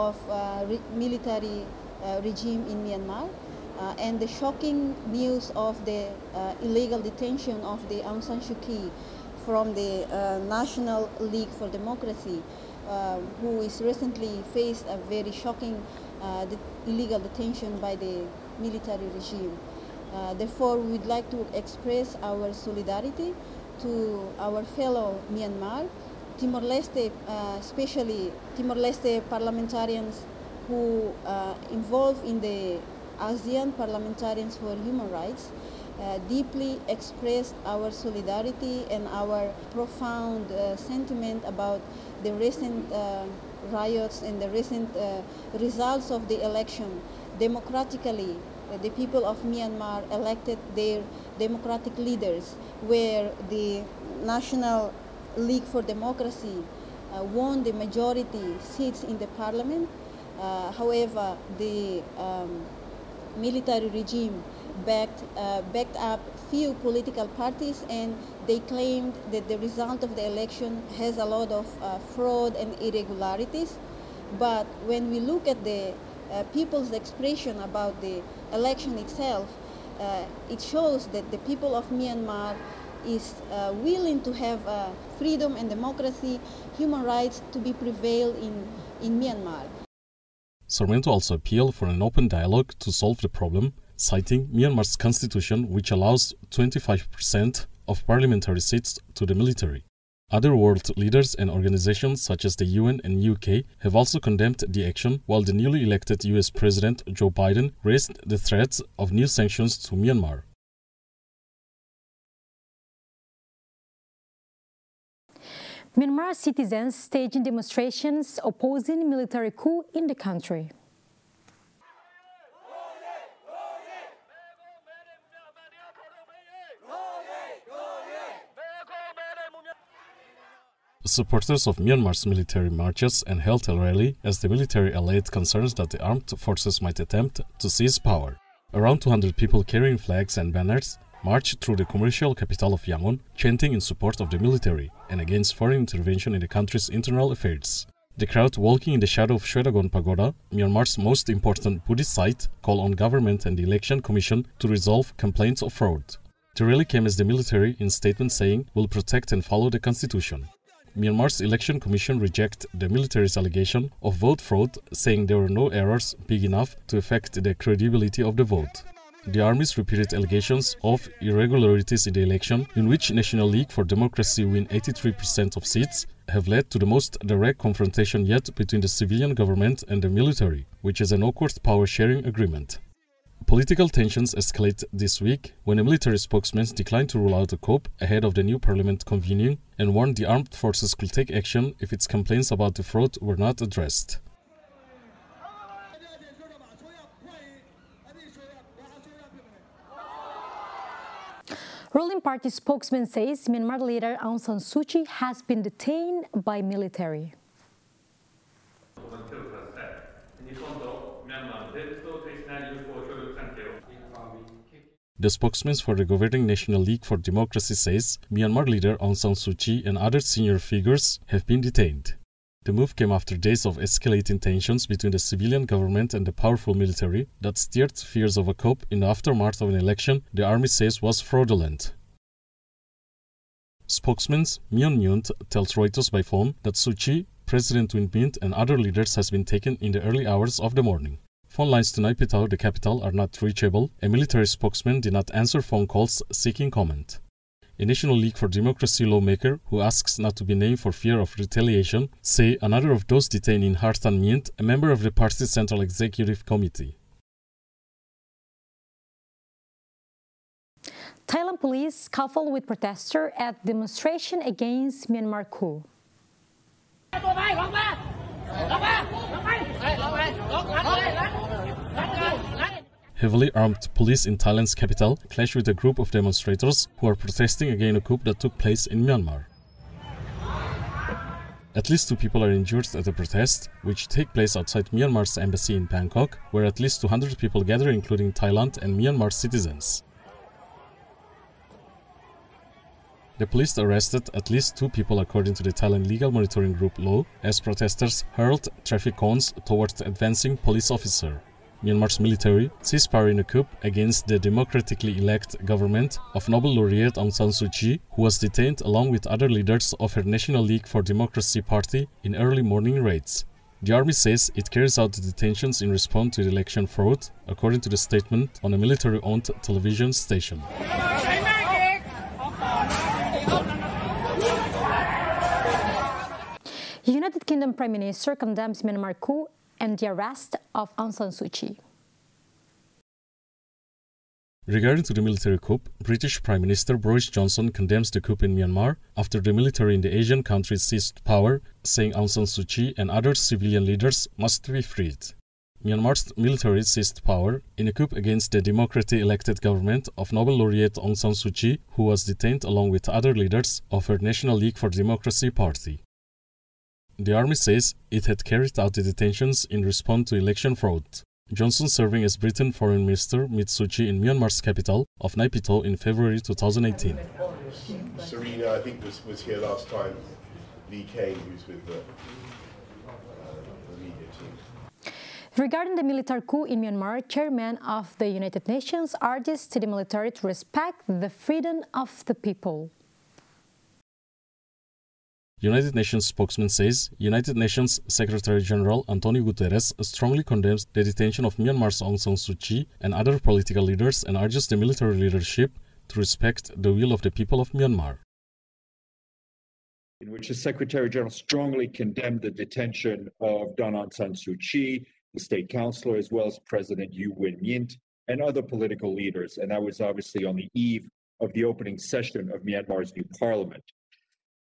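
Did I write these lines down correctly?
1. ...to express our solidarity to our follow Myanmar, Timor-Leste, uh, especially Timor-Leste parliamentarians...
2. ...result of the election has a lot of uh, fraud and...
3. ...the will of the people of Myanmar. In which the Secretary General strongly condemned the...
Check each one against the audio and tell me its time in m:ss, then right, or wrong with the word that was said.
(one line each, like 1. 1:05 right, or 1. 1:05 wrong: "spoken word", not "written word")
1. 0:21 wrong: "fellow", not "follow"
2. 1:09 right
3. 6:36 right.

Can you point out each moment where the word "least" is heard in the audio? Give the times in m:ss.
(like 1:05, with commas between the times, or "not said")
4:41, 4:46, 4:54.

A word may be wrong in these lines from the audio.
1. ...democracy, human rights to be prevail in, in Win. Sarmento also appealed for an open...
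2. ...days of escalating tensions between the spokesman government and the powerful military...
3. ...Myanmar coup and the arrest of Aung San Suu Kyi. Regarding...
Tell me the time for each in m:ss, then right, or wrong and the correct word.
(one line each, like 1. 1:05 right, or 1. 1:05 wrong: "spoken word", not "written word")
1. 1:25 wrong: "Myanmar", not "Win"
2. 3:43 wrong: "civilian", not "spokesman"
3. 5:28 right.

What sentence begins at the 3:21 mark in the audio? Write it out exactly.
Ruling party spokesman says Myanmar leader Aung San Suu Kyi has been detained by military.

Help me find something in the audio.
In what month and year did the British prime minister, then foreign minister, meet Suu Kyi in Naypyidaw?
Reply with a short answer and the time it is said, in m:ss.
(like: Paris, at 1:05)
February 2018, at 6:05.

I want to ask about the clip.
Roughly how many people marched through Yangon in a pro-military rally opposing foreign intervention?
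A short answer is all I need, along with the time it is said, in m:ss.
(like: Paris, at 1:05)
200, at 2:18.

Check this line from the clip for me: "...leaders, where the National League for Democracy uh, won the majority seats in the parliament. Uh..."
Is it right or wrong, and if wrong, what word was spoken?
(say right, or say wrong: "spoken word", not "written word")
right.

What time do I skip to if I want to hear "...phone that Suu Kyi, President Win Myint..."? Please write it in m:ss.
3:56.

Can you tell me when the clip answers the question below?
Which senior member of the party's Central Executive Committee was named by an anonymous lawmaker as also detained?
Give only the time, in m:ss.
4:13.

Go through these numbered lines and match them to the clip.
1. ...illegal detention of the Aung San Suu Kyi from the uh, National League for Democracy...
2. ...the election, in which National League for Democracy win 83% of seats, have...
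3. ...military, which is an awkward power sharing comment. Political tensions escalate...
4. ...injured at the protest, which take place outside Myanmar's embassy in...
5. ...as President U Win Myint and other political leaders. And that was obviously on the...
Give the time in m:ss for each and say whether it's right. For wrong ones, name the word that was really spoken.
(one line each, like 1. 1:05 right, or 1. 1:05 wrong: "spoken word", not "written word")
1. 0:06 right
2. 2:52 right
3. 3:00 wrong: "agreement", not "comment"
4. 4:42 right
5. 6:46 right.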